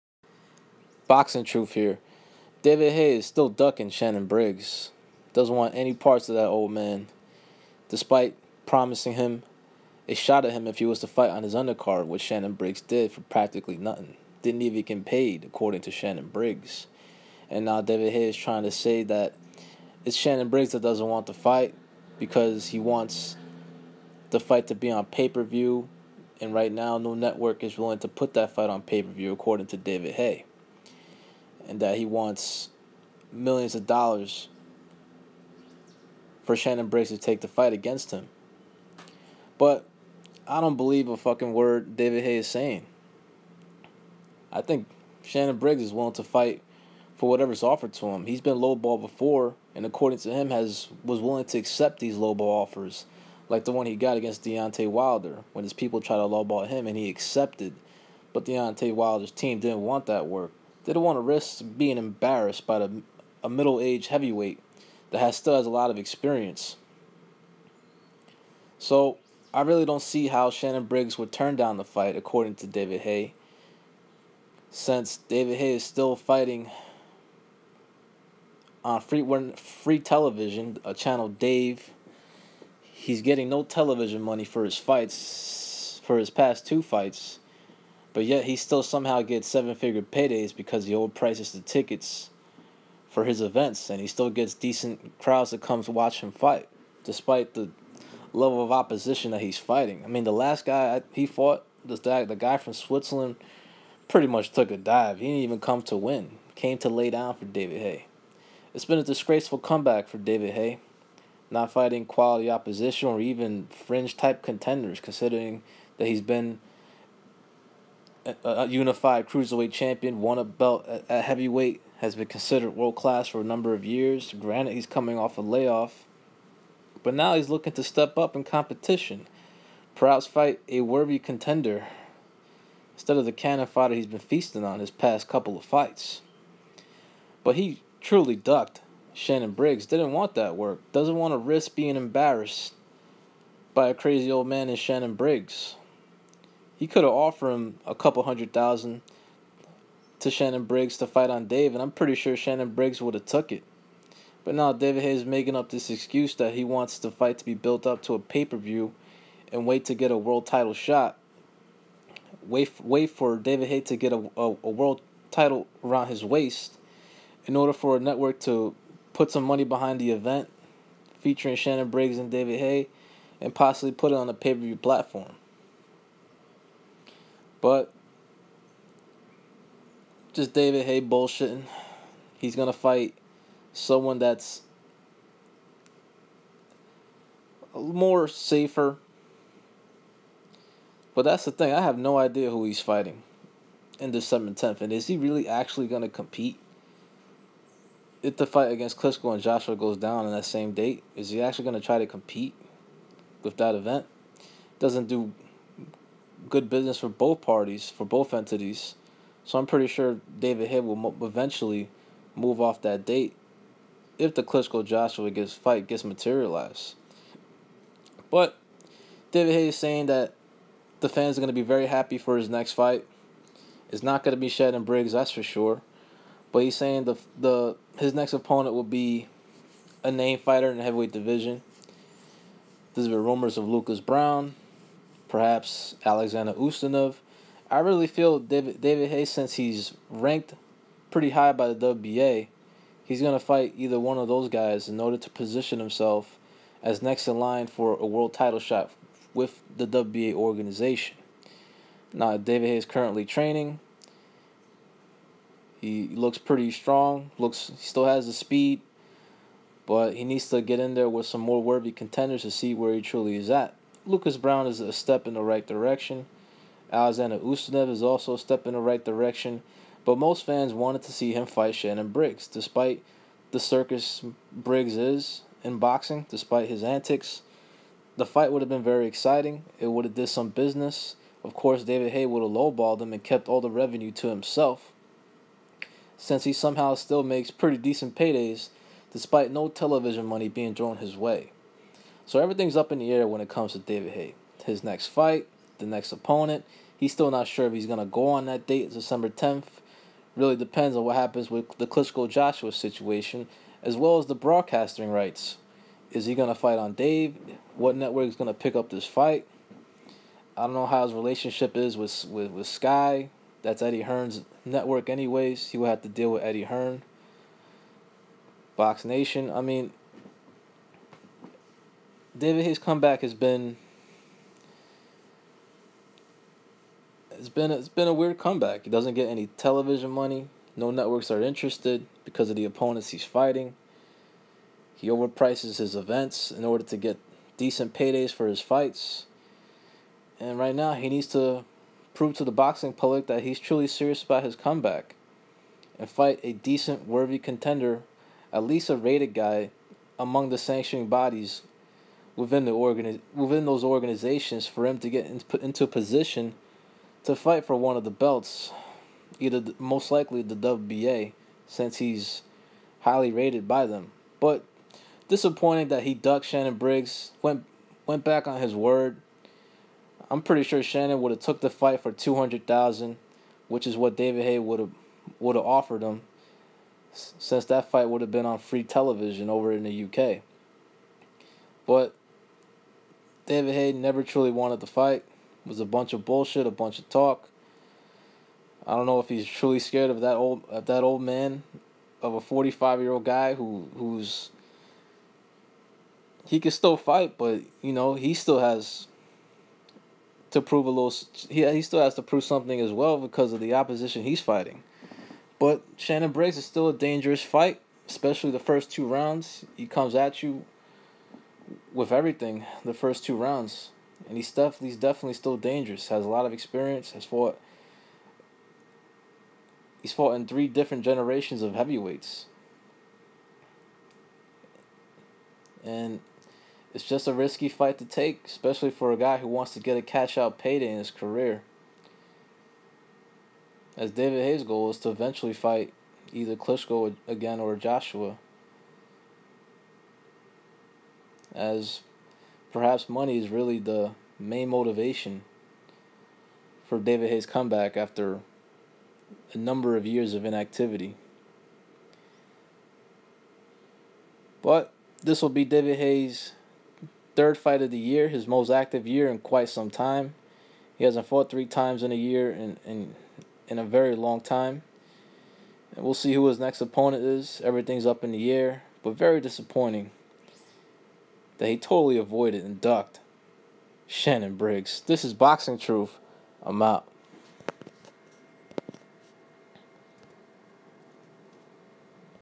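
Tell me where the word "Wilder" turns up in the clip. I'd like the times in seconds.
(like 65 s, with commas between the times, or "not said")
54 s, 58 s.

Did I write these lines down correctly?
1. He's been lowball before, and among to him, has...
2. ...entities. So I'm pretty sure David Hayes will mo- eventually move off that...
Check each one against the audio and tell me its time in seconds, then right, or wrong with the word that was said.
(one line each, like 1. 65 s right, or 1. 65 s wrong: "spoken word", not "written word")
1. 48 s wrong: "according", not "among"
2. 208 s wrong: "Hill", not "Hayes".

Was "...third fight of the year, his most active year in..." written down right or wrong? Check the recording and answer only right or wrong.
right.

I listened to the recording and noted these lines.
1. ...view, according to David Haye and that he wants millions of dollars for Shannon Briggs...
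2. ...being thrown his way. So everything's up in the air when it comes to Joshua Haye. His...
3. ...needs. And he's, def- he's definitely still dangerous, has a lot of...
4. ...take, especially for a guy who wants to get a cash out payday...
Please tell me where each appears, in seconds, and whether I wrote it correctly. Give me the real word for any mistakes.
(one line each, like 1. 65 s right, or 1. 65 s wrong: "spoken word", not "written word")
1. 29 s right
2. 290 s wrong: "David", not "Joshua"
3. 413 s wrong: "rounds", not "needs"
4. 428 s right.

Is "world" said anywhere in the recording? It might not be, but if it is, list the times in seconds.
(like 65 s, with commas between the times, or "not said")
122 s, 160 s, 164 s, 248 s.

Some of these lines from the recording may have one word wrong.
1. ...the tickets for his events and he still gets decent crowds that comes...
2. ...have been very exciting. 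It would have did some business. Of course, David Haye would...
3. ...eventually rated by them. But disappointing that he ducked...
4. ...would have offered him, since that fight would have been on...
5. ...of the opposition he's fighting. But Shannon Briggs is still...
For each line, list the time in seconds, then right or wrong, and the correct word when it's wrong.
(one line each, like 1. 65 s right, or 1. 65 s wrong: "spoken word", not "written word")
1. 91 s right
2. 278 s right
3. 363 s wrong: "highly", not "eventually"
4. 375 s right
5. 403 s right.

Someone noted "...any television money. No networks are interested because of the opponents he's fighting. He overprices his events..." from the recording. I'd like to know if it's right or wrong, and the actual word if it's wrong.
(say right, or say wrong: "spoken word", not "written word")
right.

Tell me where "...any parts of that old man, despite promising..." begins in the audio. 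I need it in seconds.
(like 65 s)
5 s.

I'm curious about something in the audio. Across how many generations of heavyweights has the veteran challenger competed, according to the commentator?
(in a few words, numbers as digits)
3.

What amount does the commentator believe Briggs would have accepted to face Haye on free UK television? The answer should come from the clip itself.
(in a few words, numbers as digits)
200,000.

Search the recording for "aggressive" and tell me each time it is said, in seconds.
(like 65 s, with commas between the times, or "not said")
not said.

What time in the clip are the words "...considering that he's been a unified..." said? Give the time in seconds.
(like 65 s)
114 s.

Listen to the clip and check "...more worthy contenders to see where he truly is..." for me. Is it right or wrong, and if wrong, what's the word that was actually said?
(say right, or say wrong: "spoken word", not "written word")
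right.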